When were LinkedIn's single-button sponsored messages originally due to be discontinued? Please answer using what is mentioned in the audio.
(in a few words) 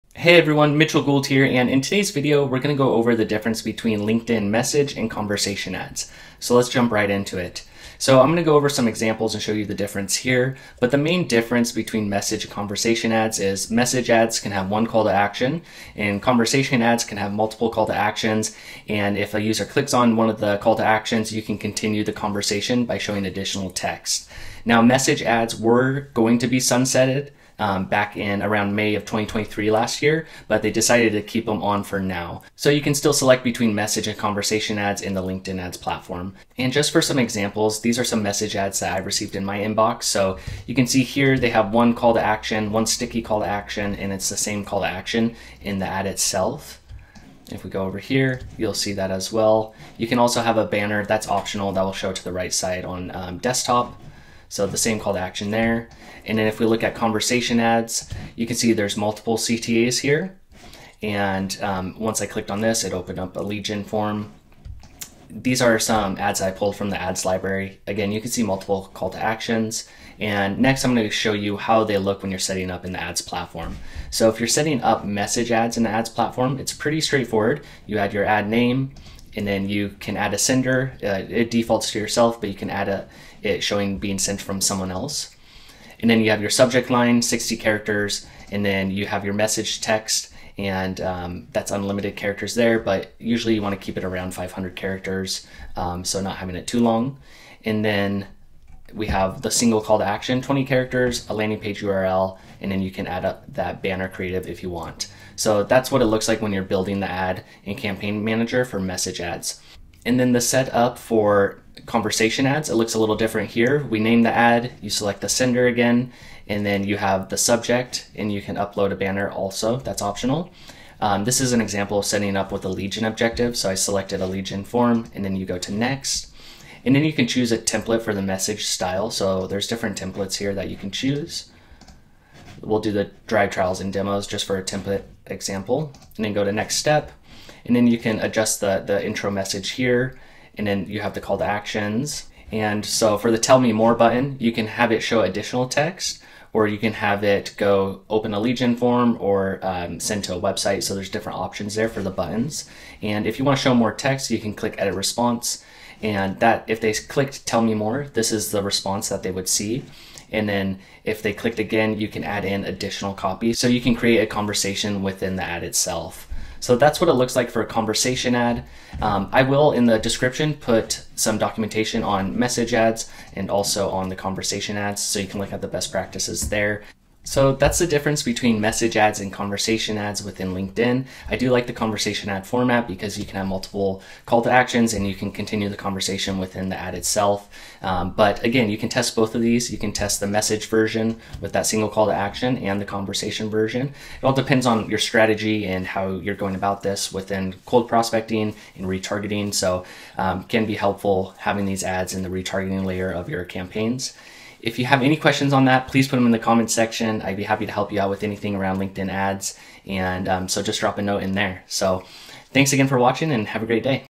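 May 2023.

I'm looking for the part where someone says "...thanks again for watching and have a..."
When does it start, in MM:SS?
03:32.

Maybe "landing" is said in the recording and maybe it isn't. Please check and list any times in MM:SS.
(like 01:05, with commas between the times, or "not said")
01:41.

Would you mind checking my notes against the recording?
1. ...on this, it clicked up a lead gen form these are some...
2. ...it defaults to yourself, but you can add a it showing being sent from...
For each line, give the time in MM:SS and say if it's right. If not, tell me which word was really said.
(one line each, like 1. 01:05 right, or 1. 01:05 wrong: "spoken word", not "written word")
1. 01:02 wrong: "opened", not "clicked"
2. 01:21 right.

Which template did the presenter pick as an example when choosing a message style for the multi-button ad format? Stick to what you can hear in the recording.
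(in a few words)
Drive trials and demos.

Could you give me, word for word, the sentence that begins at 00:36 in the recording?
And just for some examples, these these are some message ads that I received in my inbox.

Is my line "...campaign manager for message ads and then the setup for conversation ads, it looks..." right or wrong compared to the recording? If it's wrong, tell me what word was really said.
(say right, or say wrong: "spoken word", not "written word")
right.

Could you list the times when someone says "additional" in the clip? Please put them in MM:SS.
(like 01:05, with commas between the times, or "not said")
00:23, 02:25, 02:42.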